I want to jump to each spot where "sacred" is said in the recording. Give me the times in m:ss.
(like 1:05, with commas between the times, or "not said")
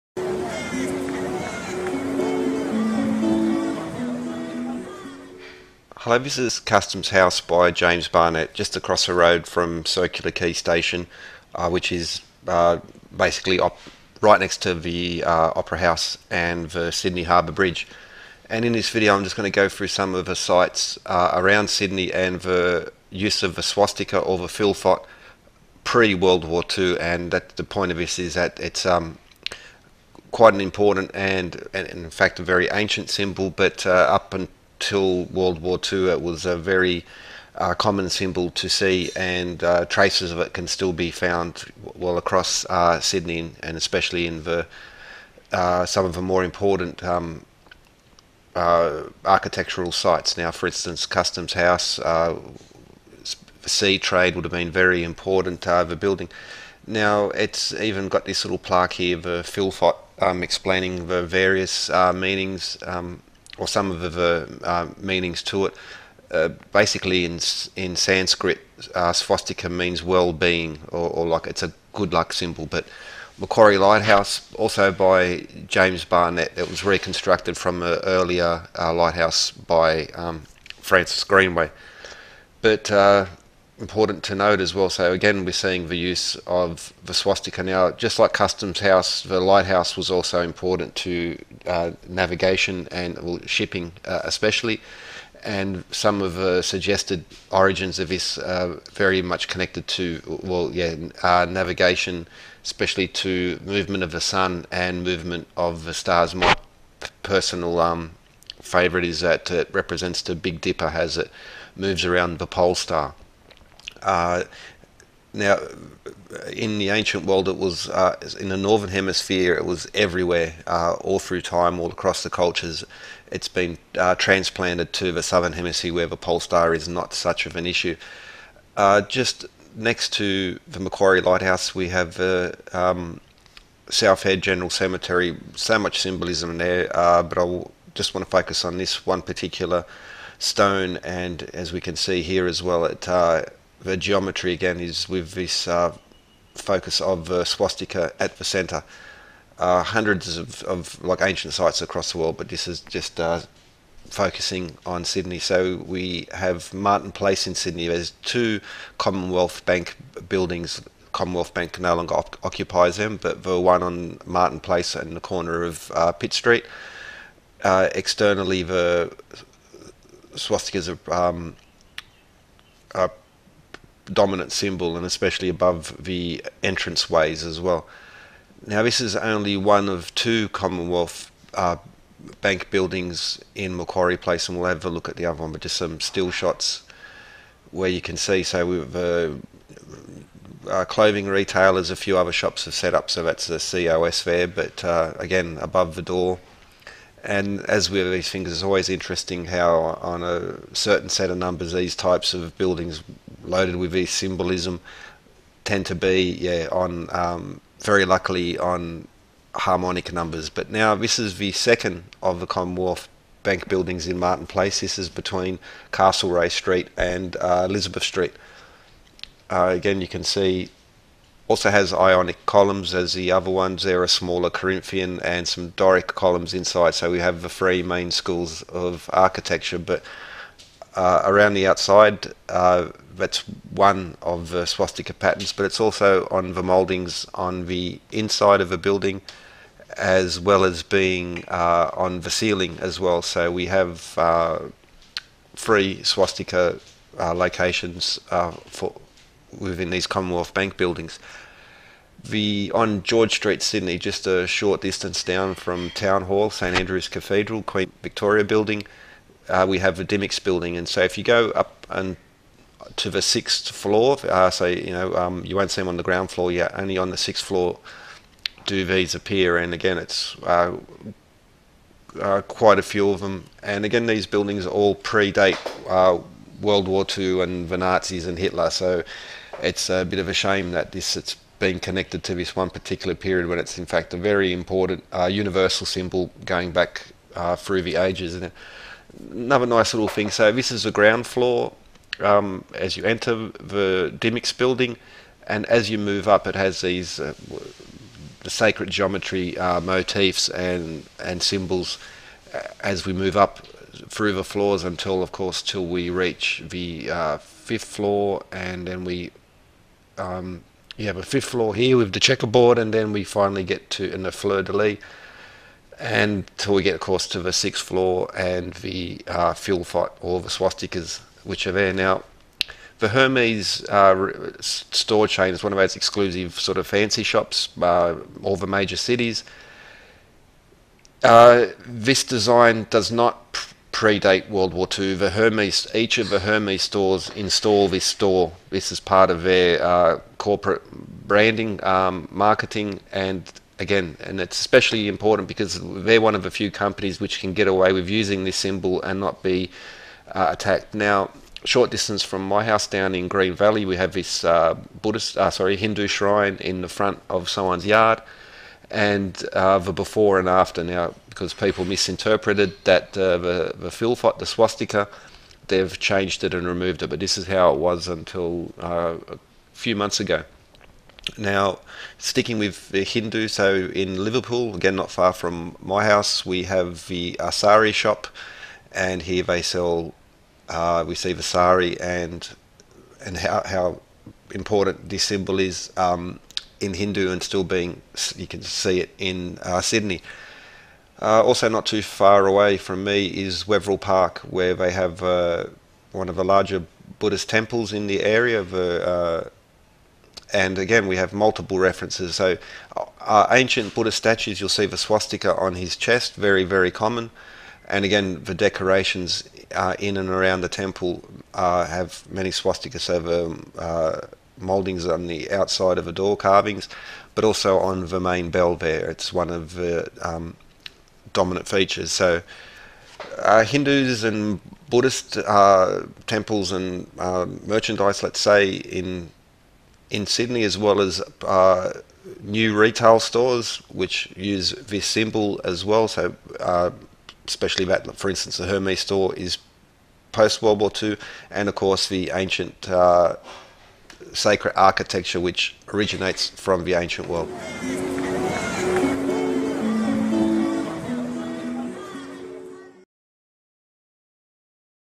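4:58, 7:24.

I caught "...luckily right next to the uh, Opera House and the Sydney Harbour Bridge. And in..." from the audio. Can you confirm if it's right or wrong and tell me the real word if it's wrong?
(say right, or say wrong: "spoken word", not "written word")
wrong: "basically", not "luckily".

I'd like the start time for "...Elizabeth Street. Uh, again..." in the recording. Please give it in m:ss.
3:37.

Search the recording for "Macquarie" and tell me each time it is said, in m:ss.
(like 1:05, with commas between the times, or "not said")
1:13, 2:10, 3:03.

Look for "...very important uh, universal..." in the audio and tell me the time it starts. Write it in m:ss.
4:44.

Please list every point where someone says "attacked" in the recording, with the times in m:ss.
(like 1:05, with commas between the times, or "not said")
5:50.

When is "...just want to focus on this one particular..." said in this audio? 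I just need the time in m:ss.
2:17.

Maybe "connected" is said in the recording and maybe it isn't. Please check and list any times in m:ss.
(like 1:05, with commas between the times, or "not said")
1:39, 4:41.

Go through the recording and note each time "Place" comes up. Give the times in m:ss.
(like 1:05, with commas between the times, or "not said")
2:37, 2:44, 3:04, 3:34.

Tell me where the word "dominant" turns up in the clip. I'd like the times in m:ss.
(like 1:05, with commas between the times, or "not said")
2:54, 7:01.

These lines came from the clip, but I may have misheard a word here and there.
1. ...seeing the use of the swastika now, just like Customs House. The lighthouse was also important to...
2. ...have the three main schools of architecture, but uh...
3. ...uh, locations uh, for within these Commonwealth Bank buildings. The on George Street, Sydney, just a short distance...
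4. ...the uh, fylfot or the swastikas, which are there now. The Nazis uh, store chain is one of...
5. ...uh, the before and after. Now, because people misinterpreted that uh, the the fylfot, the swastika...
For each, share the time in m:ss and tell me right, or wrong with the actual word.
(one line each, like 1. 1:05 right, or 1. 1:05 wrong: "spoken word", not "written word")
1. 1:25 right
2. 3:47 right
3. 4:07 right
4. 5:18 wrong: "Hermes", not "Nazis"
5. 5:59 right.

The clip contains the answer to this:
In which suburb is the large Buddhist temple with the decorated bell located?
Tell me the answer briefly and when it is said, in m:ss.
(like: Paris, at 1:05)
Wetherill Park, at 6:33.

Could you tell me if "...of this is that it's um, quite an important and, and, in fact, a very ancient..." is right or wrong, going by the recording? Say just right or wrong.
right.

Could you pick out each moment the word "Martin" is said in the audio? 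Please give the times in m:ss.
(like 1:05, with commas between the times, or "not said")
2:36, 2:44, 3:34.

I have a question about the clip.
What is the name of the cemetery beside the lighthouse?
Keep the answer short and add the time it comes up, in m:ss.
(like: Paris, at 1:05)
South Head General Cemetery, at 2:13.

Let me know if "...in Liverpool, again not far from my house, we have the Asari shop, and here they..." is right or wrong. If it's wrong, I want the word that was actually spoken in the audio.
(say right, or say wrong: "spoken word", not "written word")
right.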